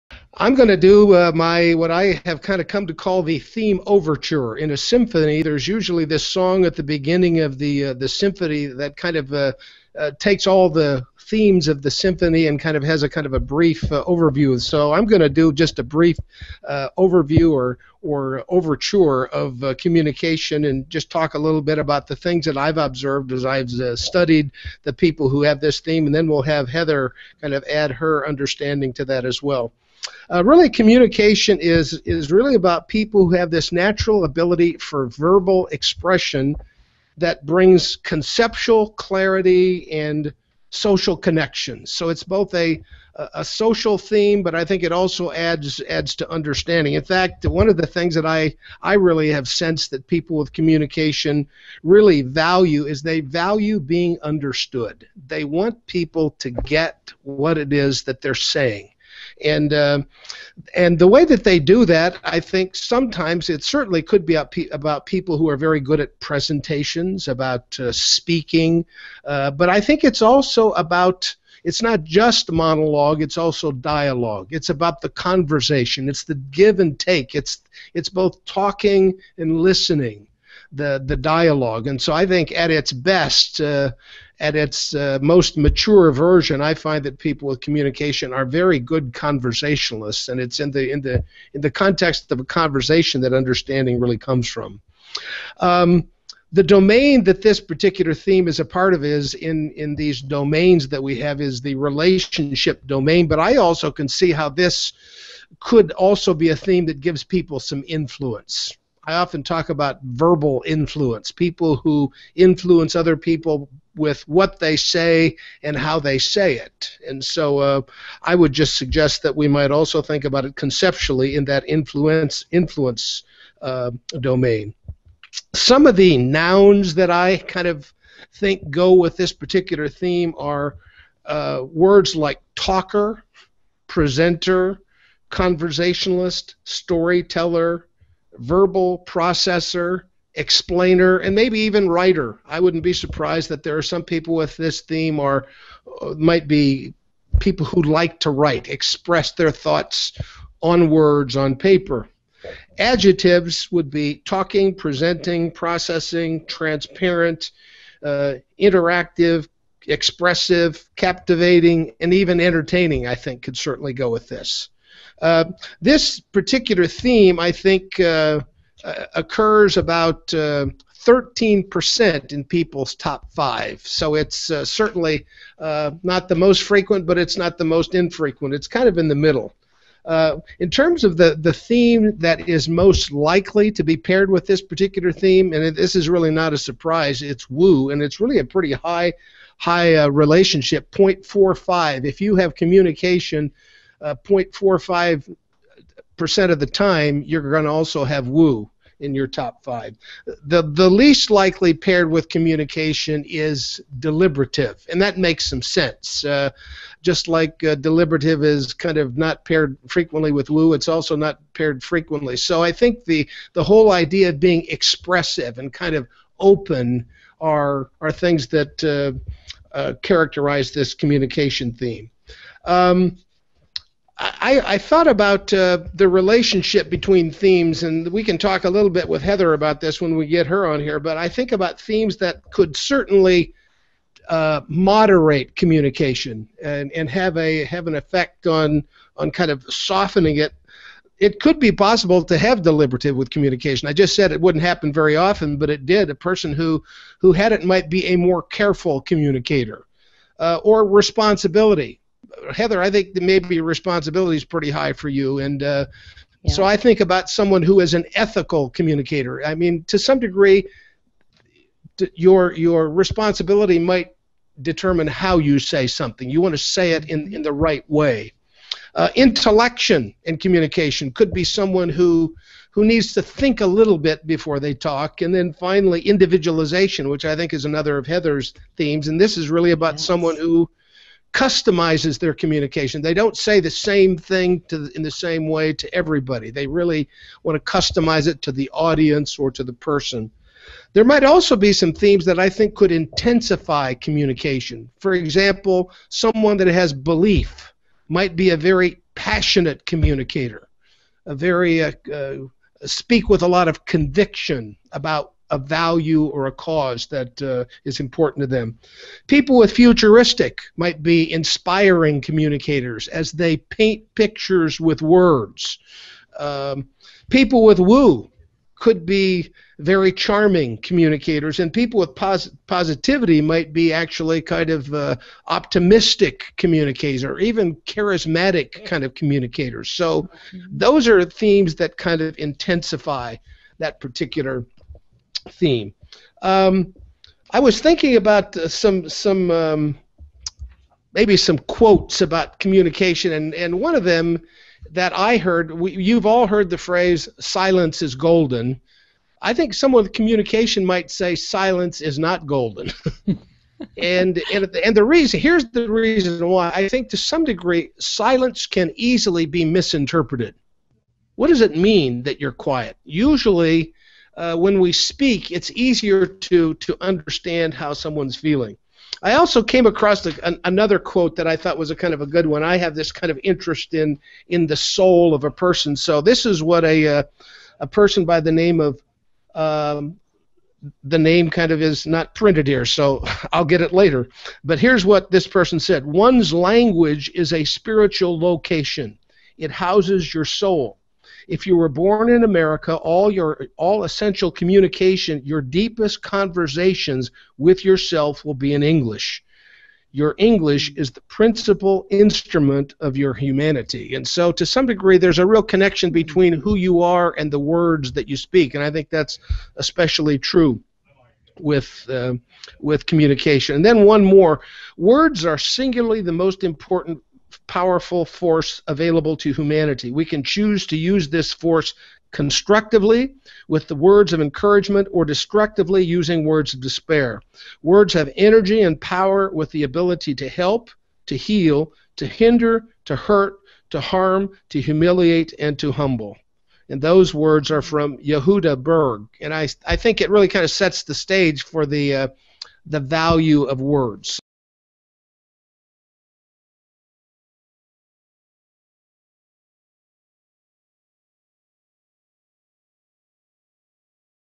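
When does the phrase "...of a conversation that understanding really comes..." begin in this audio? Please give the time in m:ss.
1:32.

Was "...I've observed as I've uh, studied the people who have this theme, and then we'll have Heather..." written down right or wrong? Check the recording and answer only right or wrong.
right.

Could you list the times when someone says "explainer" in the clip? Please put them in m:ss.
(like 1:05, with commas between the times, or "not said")
2:20.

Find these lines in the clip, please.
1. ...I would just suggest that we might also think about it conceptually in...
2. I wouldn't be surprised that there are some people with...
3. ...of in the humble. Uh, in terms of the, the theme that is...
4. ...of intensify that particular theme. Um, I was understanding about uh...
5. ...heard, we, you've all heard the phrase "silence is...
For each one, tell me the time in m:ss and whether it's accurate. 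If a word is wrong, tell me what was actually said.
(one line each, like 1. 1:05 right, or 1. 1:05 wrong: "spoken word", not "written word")
1. 1:58 right
2. 2:22 right
3. 2:58 wrong: "middle", not "humble"
4. 5:32 wrong: "thinking", not "understanding"
5. 5:45 right.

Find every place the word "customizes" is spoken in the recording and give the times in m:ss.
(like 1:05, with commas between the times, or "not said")
4:41, 4:47.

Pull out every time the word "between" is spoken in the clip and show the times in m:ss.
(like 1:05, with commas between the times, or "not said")
3:46, 6:46.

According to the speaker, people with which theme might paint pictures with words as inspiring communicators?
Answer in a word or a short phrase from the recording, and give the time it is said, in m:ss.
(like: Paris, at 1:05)
futuristic, at 5:09.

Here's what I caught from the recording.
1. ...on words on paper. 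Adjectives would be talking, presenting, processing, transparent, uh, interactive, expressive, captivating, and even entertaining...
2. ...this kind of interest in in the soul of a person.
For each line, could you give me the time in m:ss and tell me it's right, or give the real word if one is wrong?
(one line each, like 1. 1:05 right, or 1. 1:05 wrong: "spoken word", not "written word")
1. 2:30 right
2. 6:12 right.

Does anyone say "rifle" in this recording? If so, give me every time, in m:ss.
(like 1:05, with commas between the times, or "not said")
not said.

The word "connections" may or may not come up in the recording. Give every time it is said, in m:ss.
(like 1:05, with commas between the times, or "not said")
0:41, 6:45.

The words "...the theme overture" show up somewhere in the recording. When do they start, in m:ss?
0:03.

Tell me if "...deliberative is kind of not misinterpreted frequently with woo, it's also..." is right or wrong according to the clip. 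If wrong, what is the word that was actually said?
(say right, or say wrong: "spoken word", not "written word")
wrong: "paired", not "misinterpreted".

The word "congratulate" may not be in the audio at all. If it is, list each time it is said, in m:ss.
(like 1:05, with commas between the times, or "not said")
not said.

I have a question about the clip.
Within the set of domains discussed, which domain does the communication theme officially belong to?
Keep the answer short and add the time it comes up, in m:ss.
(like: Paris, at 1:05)
relationship domain, at 1:41.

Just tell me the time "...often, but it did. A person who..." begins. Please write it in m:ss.
4:05.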